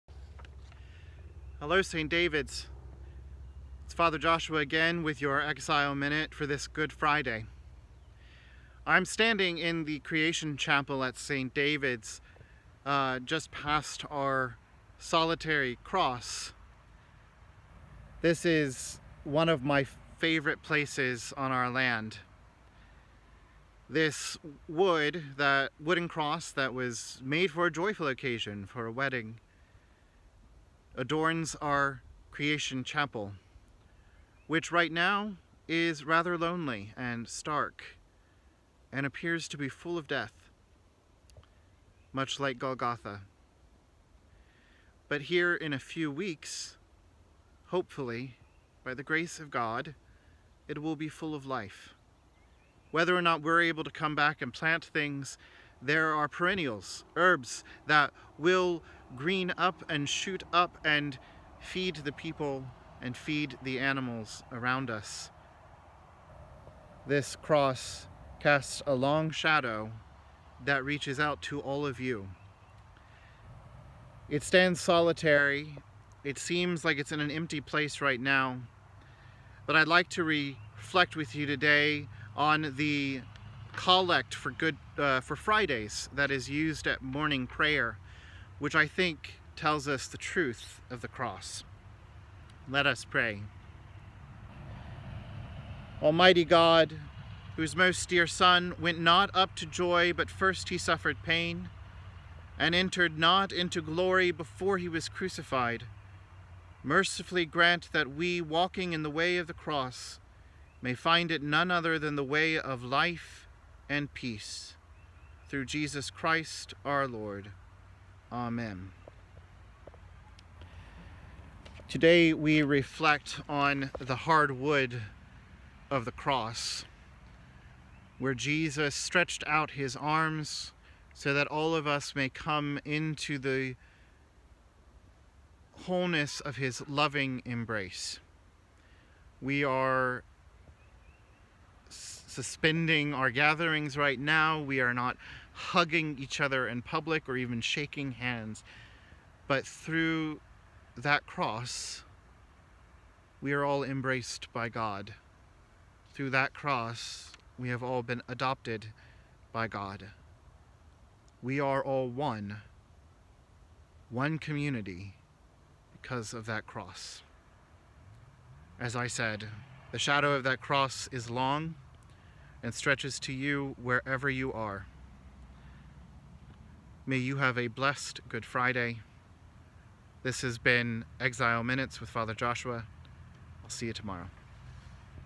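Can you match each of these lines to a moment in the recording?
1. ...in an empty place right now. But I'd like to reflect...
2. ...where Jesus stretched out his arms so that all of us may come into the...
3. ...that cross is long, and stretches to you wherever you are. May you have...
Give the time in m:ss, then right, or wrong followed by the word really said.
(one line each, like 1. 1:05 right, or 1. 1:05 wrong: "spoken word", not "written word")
1. 1:17 right
2. 2:08 right
3. 2:50 right.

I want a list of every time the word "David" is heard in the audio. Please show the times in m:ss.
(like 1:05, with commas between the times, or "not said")
0:02, 0:11.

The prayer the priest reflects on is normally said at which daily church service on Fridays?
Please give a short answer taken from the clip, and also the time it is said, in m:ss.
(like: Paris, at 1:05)
Morning prayer, at 1:27.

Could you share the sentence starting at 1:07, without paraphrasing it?
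This cross casts a long shadow that reaches out to all of you.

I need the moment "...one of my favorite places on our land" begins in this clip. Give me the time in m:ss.
0:19.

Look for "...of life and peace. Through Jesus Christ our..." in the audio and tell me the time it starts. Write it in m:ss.
1:52.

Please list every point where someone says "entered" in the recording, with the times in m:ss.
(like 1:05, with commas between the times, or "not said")
1:42.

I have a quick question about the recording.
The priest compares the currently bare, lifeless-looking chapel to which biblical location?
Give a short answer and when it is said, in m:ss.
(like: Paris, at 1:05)
Golgotha, at 0:42.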